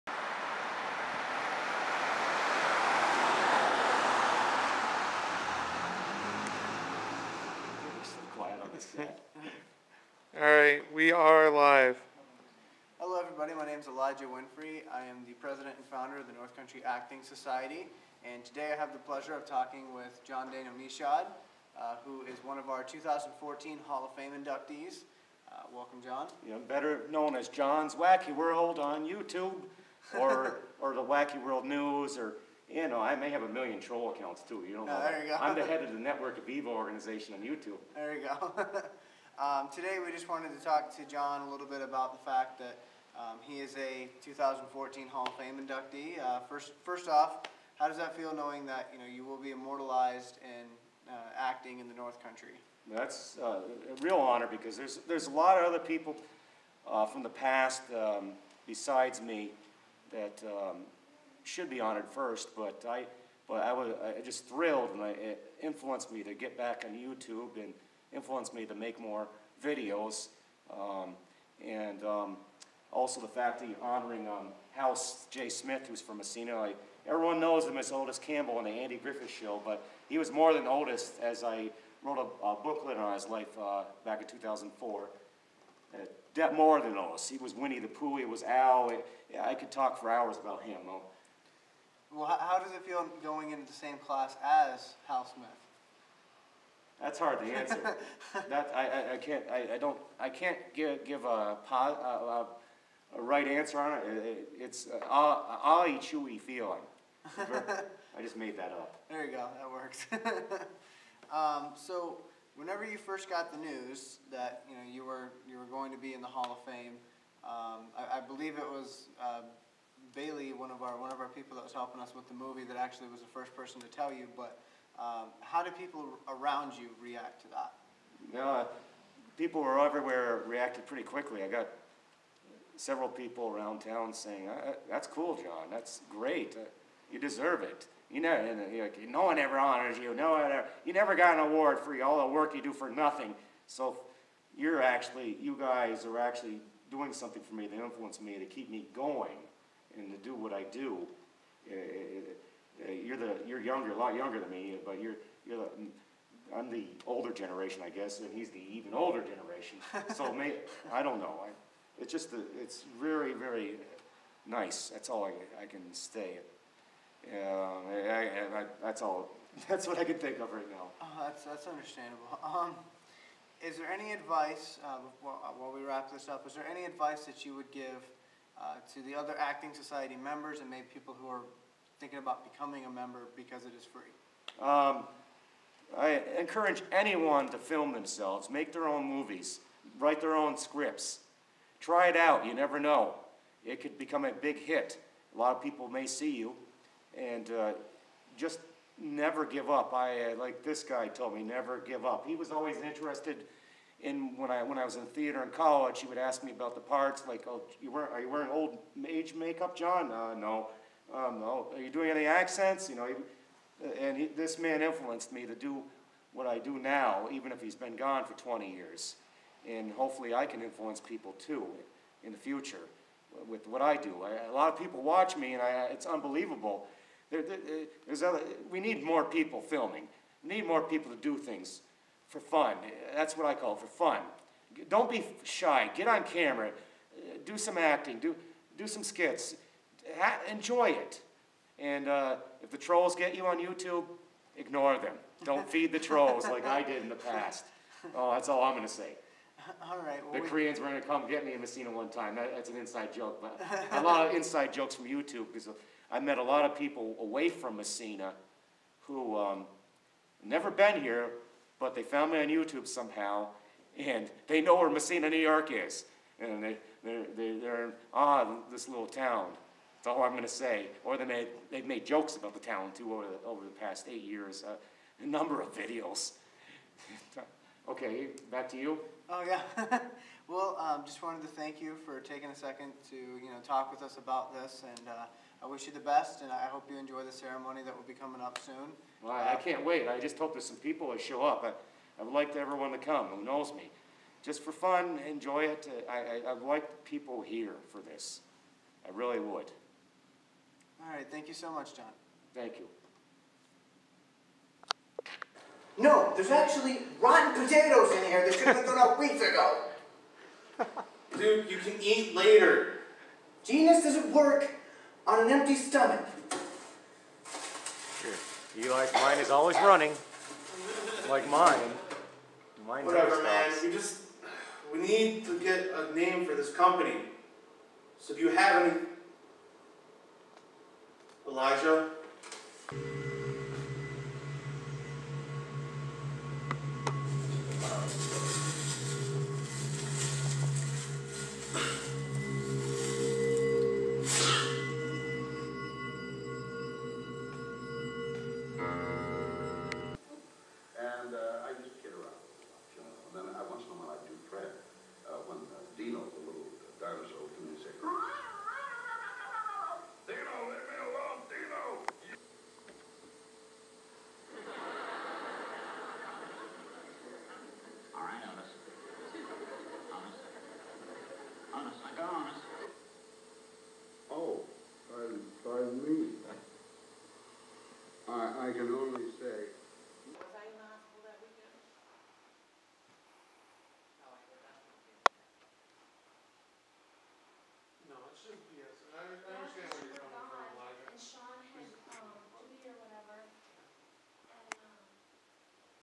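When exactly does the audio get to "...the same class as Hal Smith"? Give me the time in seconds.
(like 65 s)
93 s.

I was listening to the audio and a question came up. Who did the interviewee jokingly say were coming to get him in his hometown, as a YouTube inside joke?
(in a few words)
Koreans.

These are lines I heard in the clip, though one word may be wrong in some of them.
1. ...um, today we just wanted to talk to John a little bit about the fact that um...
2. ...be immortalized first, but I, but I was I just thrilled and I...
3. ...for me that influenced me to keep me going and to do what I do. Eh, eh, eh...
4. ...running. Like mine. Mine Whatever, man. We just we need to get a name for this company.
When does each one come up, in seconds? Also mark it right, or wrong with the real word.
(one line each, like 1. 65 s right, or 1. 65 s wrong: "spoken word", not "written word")
1. 39 s right
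2. 61 s wrong: "honored", not "immortalized"
3. 147 s right
4. 319 s right.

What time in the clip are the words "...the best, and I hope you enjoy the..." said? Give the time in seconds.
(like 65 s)
285 s.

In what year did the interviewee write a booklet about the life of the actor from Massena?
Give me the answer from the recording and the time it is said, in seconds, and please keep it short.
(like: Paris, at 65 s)
2004, at 84 s.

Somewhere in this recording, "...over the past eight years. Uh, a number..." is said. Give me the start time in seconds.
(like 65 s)
273 s.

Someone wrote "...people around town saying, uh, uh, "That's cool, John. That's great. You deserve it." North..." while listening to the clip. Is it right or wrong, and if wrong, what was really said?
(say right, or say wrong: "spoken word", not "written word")
wrong: "You", not "North".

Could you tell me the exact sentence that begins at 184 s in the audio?
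Um, I encourage anyone to film themselves, make their own movies, write their own scripts.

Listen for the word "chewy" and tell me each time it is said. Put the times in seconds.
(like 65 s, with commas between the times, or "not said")
105 s.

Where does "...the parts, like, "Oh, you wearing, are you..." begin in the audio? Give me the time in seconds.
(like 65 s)
206 s.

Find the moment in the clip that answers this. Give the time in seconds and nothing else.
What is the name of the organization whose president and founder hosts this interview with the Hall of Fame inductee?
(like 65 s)
16 s.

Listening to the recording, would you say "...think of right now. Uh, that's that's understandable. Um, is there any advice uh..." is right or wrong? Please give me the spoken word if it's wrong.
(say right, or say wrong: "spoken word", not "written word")
right.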